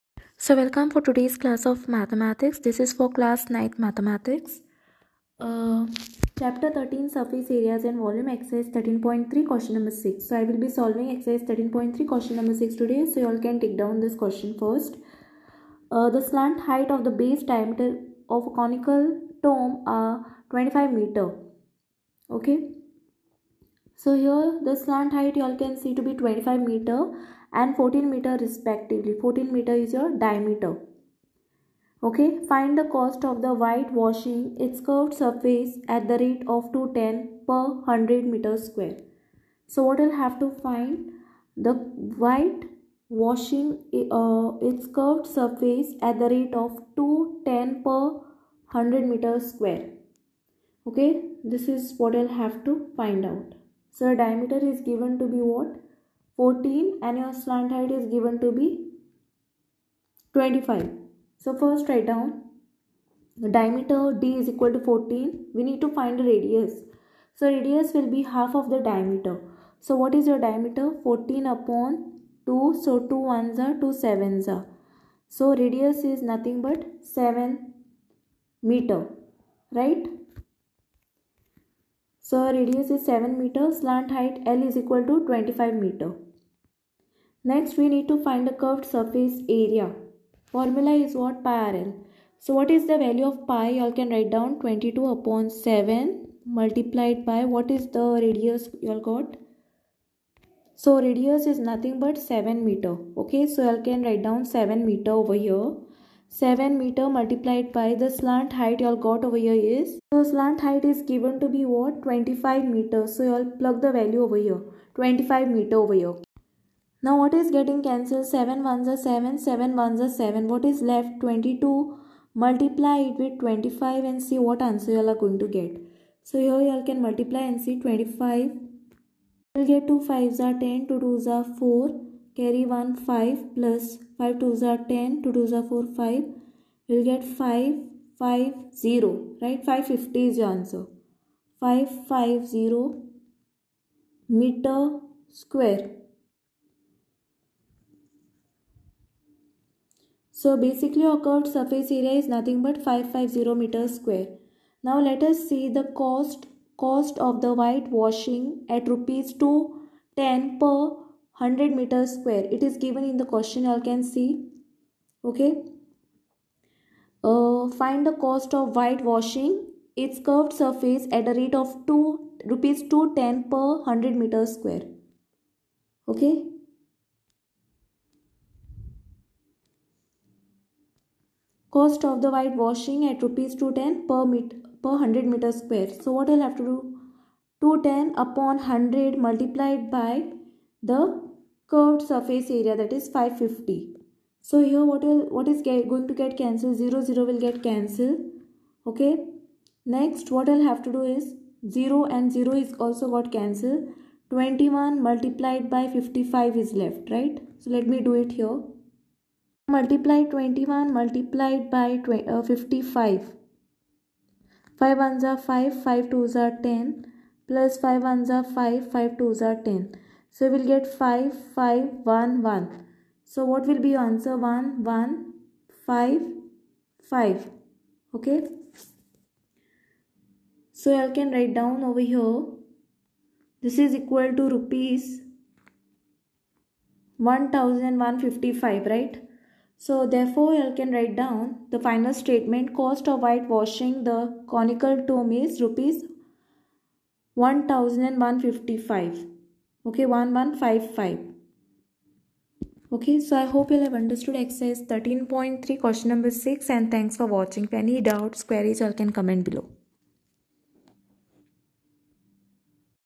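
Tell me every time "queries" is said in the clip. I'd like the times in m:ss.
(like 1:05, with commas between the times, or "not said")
4:18.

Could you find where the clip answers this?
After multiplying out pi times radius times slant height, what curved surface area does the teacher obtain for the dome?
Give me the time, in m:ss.
2:32.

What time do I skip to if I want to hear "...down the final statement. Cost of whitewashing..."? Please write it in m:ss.
4:01.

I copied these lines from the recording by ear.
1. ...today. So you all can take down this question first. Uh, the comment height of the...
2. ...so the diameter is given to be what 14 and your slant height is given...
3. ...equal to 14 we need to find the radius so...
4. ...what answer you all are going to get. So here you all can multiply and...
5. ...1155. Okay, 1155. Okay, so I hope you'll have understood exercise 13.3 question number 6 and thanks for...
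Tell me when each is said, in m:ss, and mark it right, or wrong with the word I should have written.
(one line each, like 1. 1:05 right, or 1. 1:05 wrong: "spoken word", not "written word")
1. 0:12 wrong: "slant", not "comment"
2. 0:53 right
3. 1:04 right
4. 2:04 right
5. 4:07 right.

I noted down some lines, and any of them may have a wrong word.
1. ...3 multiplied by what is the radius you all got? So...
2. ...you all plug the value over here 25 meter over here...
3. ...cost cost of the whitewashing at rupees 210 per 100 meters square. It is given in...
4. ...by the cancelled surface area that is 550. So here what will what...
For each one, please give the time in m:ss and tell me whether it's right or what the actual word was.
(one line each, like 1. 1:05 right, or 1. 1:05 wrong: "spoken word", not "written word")
1. 1:35 wrong: "7", not "3"
2. 1:53 right
3. 2:35 right
4. 3:09 wrong: "curved", not "cancelled".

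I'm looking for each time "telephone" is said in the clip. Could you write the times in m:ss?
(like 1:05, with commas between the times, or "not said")
not said.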